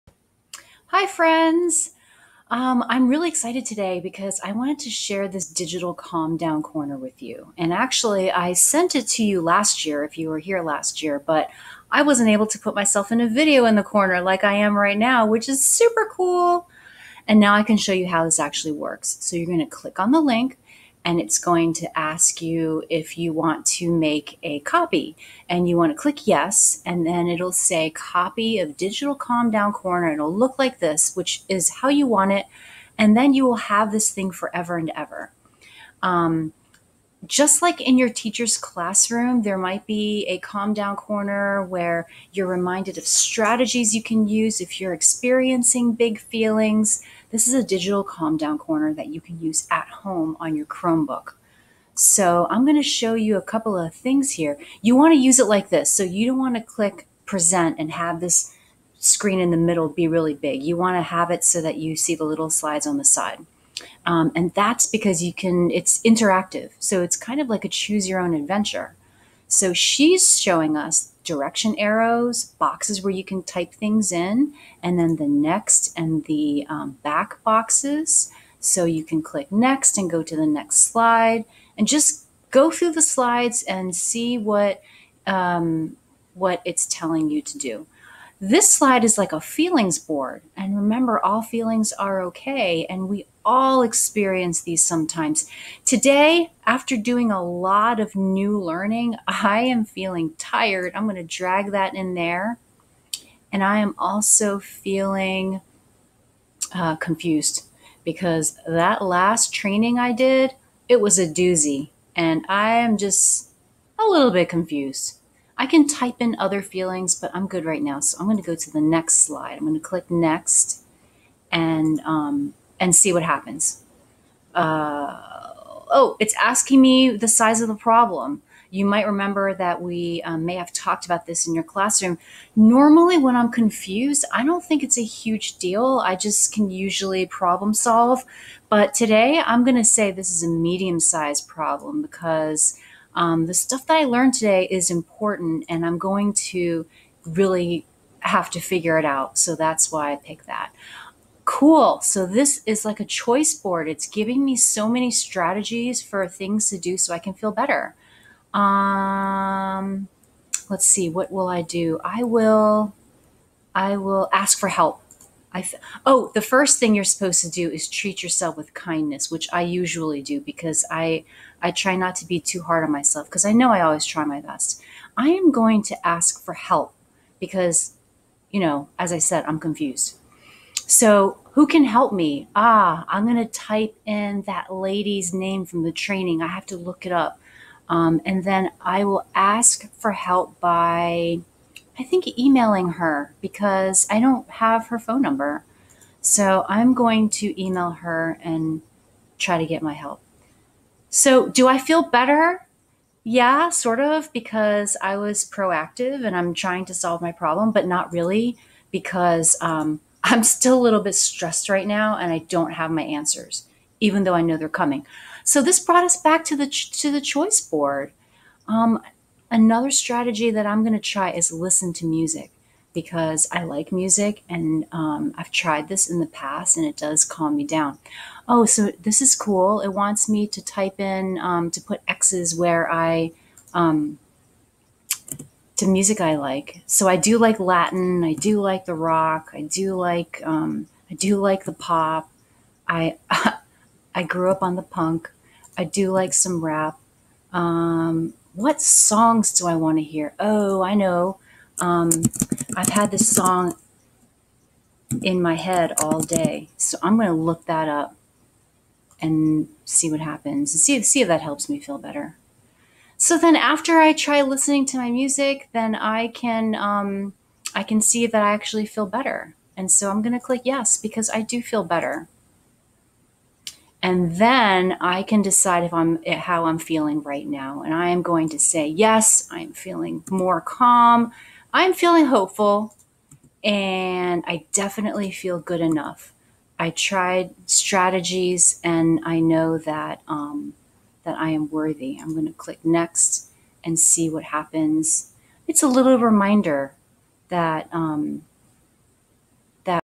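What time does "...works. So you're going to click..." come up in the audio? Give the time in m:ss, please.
0:18.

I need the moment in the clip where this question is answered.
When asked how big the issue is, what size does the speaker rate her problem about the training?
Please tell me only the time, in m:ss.
2:20.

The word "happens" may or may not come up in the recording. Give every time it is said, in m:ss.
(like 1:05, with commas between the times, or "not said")
2:03, 4:20, 4:54.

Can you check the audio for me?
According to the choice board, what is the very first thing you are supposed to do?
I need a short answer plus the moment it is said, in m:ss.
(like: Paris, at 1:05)
treat yourself with kindness, at 2:47.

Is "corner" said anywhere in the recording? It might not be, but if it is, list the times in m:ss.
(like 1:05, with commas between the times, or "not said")
0:06, 0:13, 0:29, 0:40, 0:48.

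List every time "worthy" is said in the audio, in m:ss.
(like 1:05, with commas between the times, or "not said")
4:51.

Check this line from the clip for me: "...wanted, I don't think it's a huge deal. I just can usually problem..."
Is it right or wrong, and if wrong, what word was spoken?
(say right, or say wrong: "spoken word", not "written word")
wrong: "confused", not "wanted".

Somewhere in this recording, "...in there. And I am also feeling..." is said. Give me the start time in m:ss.
1:41.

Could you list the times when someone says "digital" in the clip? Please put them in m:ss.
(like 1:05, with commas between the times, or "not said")
0:05, 0:28, 0:47.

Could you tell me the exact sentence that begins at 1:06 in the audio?
So it's kind of like a choose your own adventure.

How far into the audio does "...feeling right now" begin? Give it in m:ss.
4:36.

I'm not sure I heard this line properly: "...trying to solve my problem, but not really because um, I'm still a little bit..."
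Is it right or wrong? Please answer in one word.
right.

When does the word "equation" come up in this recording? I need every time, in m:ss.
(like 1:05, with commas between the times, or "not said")
not said.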